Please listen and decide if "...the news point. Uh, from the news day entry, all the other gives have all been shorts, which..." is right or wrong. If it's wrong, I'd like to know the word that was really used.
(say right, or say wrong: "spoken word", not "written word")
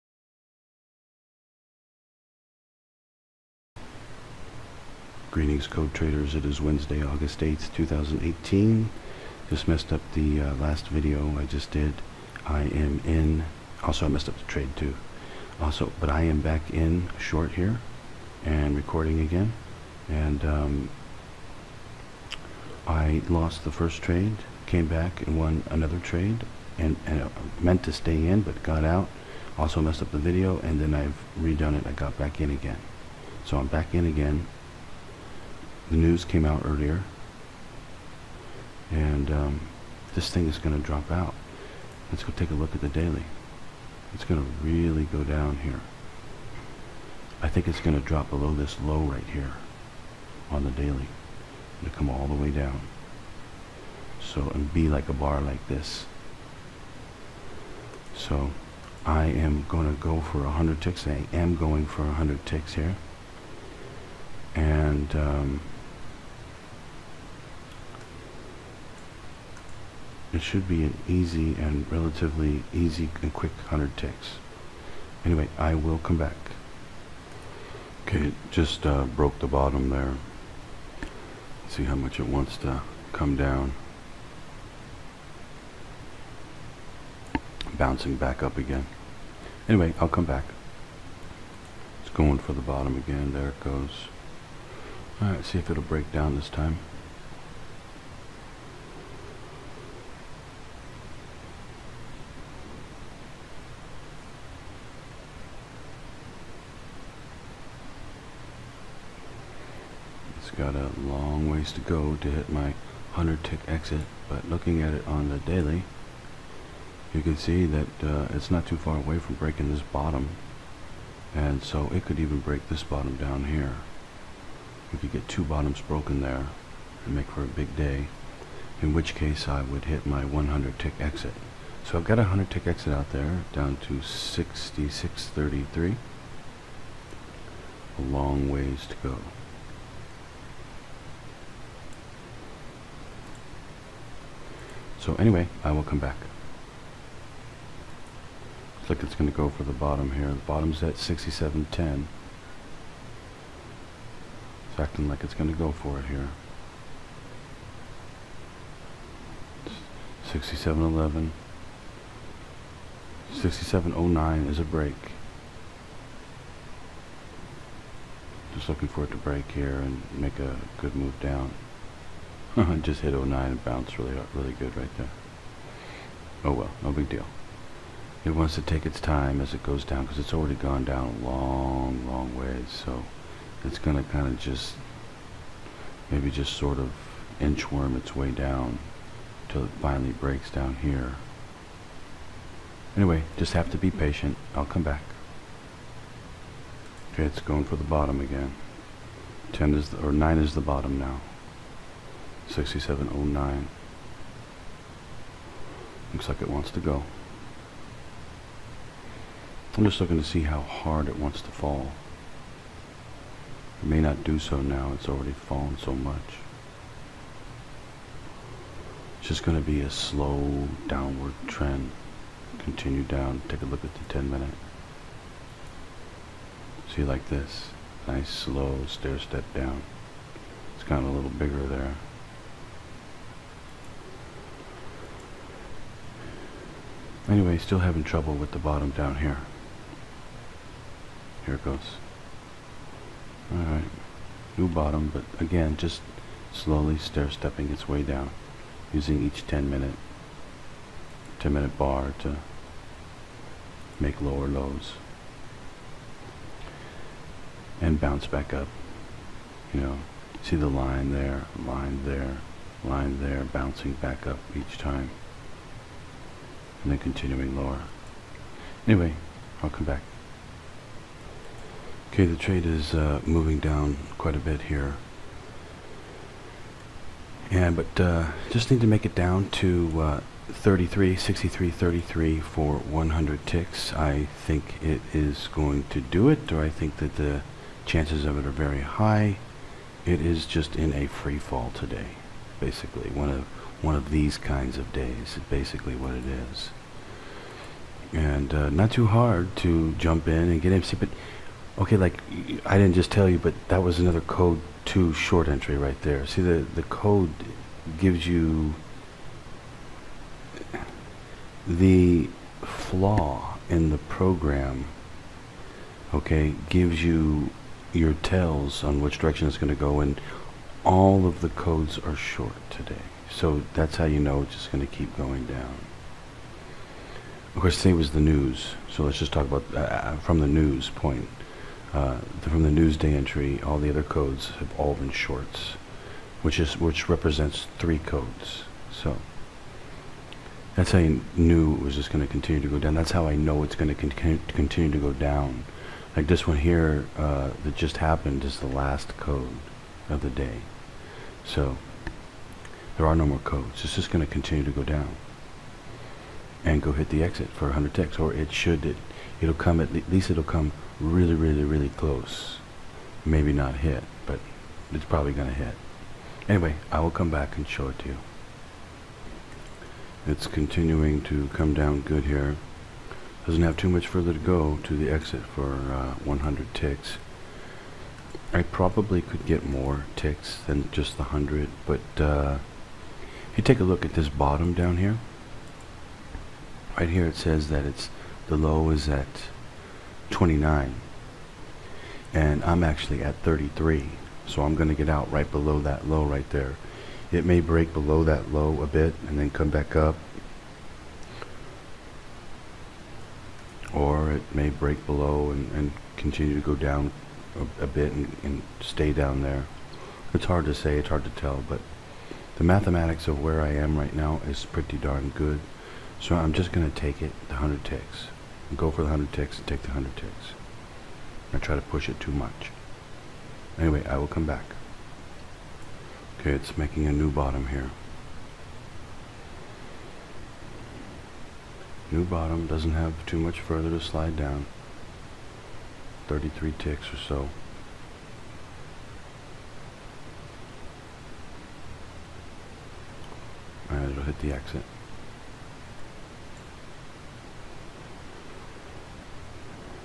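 wrong: "codes", not "gives".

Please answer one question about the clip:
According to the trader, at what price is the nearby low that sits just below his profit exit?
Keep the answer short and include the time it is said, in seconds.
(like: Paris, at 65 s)
29, at 390 s.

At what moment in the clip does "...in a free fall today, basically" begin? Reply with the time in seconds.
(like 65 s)
290 s.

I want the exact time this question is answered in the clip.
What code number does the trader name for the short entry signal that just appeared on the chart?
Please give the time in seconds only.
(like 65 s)
304 s.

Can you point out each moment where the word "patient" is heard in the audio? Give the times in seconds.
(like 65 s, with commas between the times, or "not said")
193 s.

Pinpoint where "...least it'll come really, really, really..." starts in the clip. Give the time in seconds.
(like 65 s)
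360 s.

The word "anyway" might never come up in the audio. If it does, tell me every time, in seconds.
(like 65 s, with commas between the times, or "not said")
75 s, 89 s, 145 s, 192 s, 237 s, 268 s, 366 s, 423 s.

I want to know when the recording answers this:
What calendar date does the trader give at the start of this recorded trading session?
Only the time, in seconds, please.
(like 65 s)
7 s.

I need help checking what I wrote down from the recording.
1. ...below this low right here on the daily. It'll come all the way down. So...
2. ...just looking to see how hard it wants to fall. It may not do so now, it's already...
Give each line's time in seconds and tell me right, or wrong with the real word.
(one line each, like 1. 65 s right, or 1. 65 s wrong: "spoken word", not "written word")
1. 48 s right
2. 209 s right.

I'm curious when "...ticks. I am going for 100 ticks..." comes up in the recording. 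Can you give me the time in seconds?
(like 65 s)
60 s.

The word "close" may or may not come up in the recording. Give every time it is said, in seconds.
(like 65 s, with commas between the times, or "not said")
361 s.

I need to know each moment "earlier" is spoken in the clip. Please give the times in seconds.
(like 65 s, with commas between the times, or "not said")
36 s.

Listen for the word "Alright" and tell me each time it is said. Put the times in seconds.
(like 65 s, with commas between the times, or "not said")
95 s, 243 s.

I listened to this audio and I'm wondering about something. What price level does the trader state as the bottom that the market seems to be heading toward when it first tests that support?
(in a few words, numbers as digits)
67.10.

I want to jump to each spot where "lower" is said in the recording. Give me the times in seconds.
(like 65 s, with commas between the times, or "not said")
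254 s, 267 s.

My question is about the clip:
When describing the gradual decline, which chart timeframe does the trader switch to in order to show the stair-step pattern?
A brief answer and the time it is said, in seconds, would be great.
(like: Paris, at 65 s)
10 minute, at 224 s.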